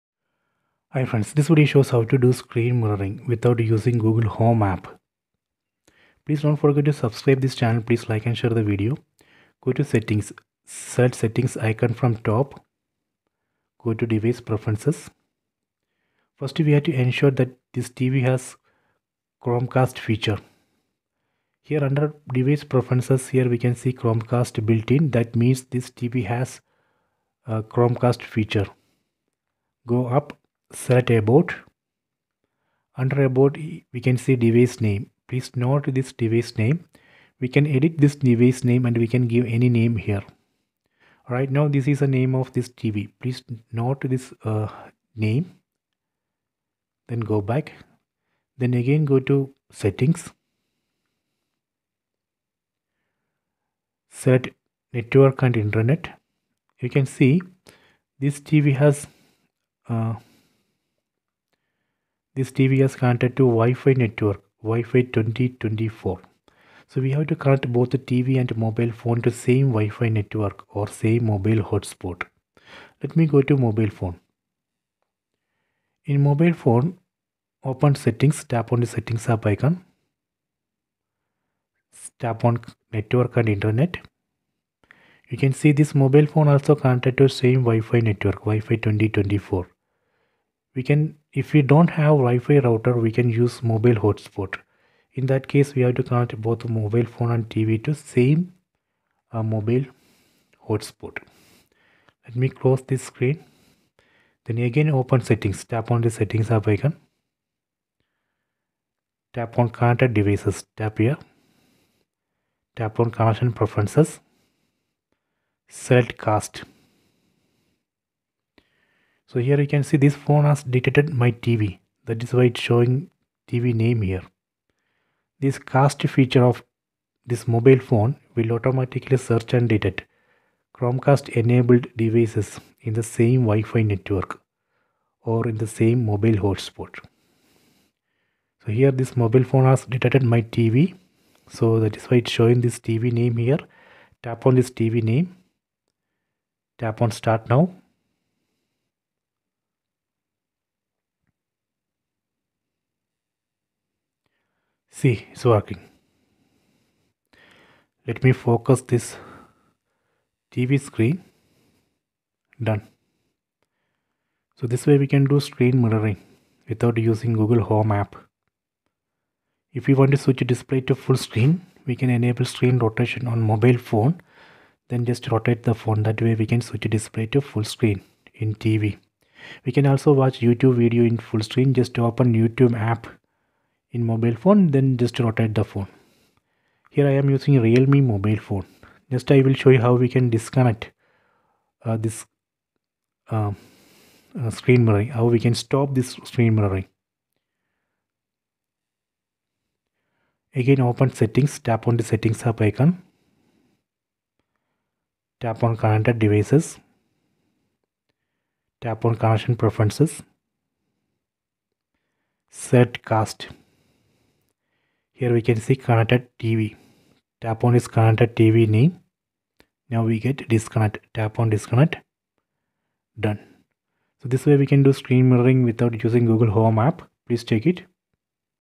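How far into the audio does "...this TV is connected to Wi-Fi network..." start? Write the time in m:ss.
1:02.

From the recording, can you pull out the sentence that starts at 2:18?
So here this mobile phone has detected my TV.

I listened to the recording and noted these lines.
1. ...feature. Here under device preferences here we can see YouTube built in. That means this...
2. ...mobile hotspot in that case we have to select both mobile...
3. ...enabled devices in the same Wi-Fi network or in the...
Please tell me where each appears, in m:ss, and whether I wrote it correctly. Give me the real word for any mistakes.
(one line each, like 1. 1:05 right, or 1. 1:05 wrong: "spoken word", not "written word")
1. 0:19 wrong: "Chromecast", not "YouTube"
2. 1:33 wrong: "connect", not "select"
3. 2:11 right.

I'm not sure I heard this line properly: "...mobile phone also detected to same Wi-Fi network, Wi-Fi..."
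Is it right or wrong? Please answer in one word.
wrong.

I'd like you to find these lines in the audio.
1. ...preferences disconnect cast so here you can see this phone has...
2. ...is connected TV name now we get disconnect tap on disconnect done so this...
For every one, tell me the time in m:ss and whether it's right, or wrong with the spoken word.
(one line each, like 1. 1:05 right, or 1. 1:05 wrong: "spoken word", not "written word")
1. 1:53 wrong: "select", not "disconnect"
2. 3:37 right.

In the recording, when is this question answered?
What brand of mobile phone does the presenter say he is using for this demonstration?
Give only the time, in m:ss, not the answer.
3:07.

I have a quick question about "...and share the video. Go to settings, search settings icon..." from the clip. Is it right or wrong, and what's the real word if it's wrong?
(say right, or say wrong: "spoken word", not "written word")
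right.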